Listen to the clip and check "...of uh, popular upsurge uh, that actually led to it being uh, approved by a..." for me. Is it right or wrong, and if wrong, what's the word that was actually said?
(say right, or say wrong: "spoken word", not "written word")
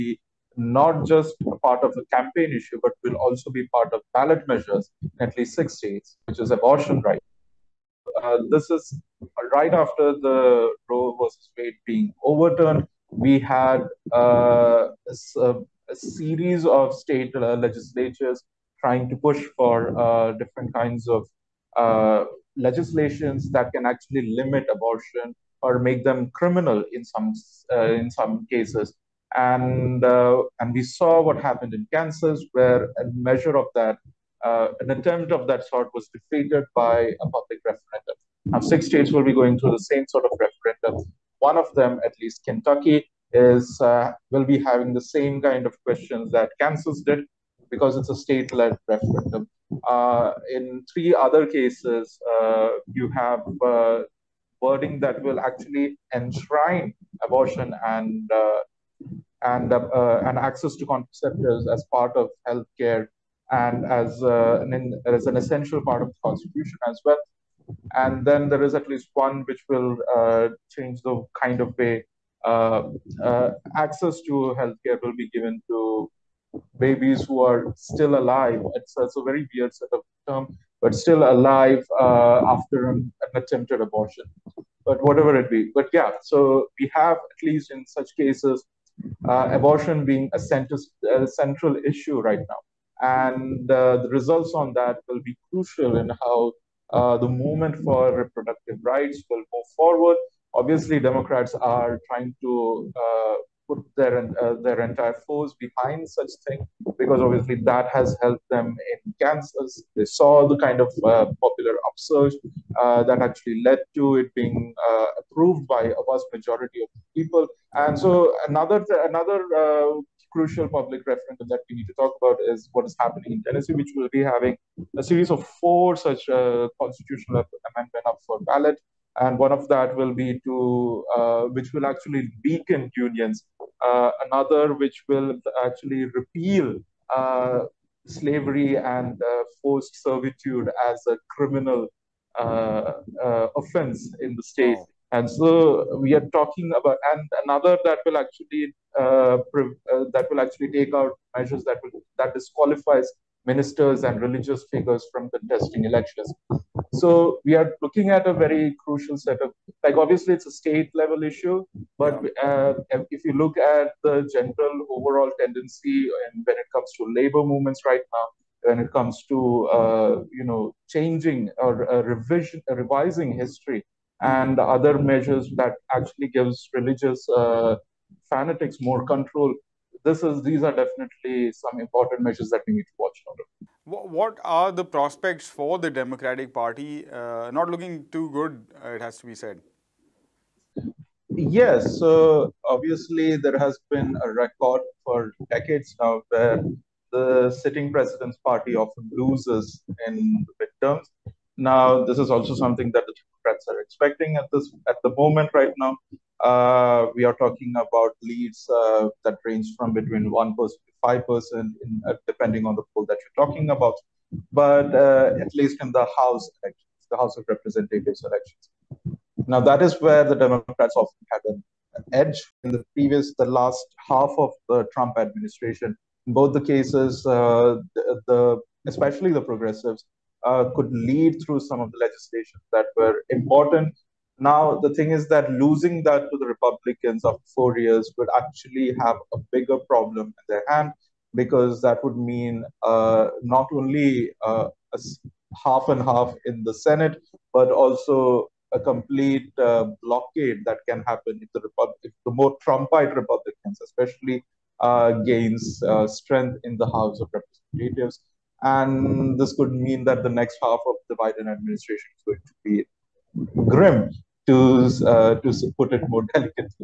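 right.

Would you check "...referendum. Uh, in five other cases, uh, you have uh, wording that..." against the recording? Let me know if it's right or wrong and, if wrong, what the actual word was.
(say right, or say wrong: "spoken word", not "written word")
wrong: "three", not "five".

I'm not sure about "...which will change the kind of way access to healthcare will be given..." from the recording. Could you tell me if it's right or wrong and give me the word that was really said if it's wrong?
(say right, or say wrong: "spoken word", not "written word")
right.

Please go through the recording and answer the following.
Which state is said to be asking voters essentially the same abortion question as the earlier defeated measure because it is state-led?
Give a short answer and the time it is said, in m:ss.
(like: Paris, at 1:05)
Kentucky, at 0:42.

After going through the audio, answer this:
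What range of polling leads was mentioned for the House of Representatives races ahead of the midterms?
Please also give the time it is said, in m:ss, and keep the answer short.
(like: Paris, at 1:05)
1% to 5%, at 3:30.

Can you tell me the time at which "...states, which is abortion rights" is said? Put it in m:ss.
0:05.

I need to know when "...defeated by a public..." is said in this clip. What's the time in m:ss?
0:36.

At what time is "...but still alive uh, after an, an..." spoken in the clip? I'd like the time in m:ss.
1:20.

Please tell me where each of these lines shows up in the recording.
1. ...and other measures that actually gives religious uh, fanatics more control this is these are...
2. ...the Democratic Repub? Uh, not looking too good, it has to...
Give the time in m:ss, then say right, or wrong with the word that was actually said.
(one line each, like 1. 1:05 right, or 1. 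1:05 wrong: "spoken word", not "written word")
1. 2:54 right
2. 3:05 wrong: "Party", not "Repub".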